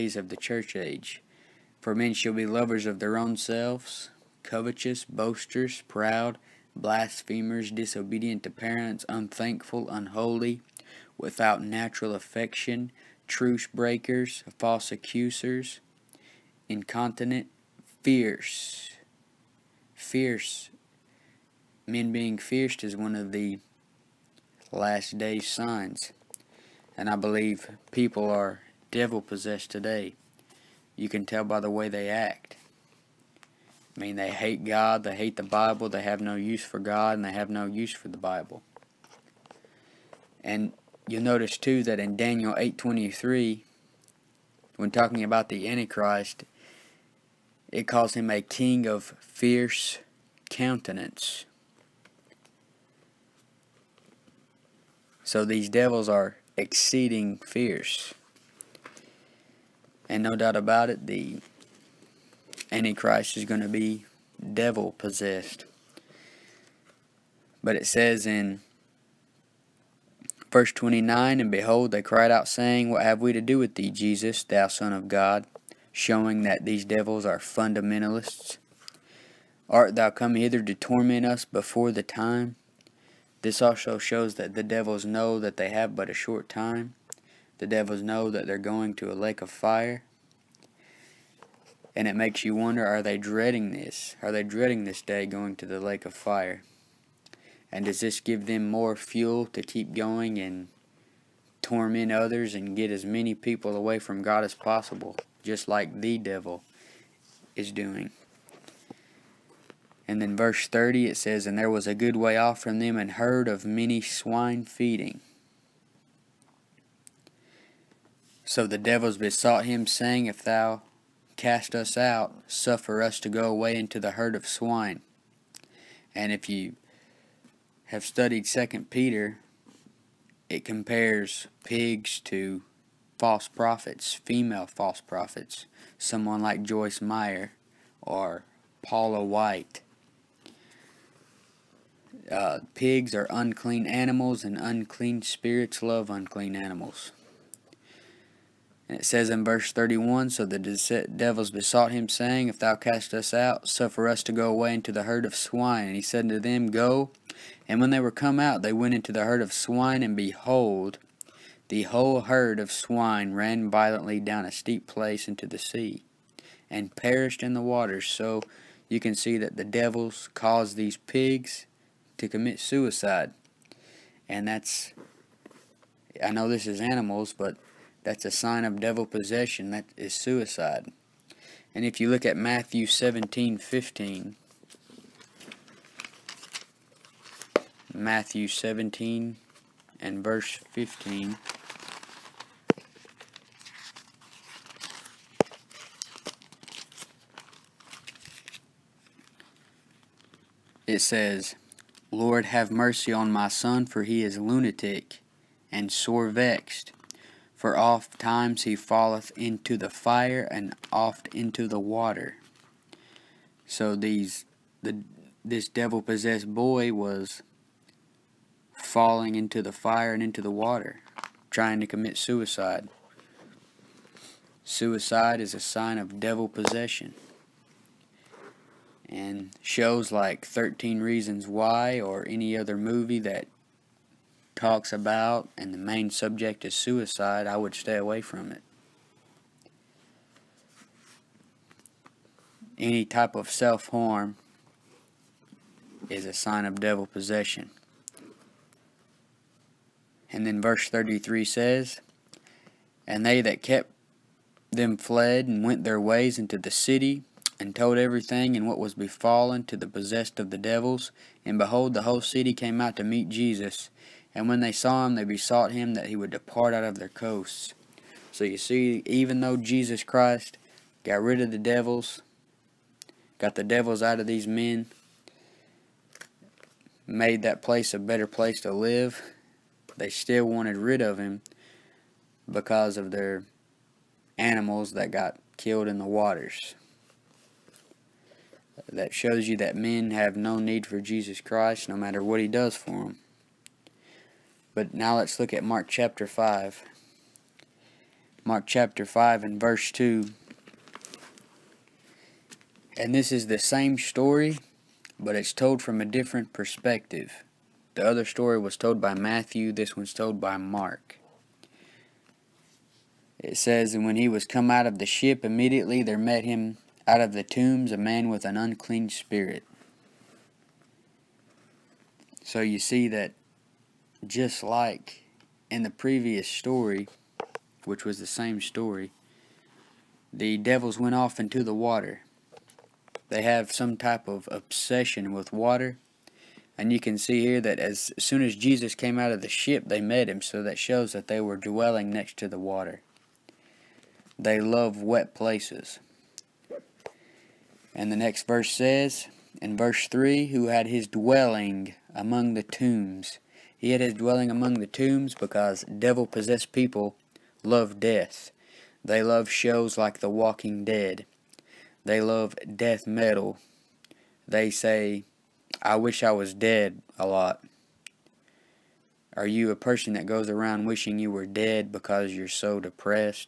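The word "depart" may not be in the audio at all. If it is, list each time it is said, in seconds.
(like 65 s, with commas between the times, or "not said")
266 s.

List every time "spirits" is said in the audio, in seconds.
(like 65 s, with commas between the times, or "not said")
145 s, 319 s.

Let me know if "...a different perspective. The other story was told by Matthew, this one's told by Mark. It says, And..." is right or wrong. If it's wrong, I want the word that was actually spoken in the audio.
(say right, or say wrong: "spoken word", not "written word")
right.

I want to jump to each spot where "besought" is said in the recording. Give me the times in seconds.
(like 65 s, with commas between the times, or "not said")
119 s, 151 s, 265 s.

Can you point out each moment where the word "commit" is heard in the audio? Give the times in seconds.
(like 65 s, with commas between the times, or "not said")
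172 s, 221 s.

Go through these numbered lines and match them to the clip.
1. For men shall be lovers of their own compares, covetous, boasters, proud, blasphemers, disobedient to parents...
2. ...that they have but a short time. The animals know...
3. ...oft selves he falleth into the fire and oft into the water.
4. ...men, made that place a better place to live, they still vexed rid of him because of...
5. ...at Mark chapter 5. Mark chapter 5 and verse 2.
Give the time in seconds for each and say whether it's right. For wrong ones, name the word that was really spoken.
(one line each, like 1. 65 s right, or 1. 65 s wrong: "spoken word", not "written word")
1. 1 s wrong: "selves", not "compares"
2. 85 s wrong: "devils", not "animals"
3. 207 s wrong: "times", not "selves"
4. 274 s wrong: "wanted", not "vexed"
5. 295 s right.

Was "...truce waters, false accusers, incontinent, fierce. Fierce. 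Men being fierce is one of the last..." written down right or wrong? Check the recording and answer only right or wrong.
wrong.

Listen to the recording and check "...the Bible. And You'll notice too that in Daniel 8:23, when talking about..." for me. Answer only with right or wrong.
right.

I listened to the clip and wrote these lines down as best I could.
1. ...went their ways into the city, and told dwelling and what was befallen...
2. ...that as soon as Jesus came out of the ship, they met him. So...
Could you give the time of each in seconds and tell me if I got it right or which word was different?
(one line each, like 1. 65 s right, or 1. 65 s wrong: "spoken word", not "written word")
1. 255 s wrong: "everything", not "dwelling"
2. 337 s right.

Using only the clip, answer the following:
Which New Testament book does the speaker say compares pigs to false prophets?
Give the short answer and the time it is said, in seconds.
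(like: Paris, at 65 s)
Second Peter, at 128 s.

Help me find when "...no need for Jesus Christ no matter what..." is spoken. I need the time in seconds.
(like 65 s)
290 s.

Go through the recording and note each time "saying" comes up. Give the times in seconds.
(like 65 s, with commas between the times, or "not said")
72 s, 119 s, 152 s.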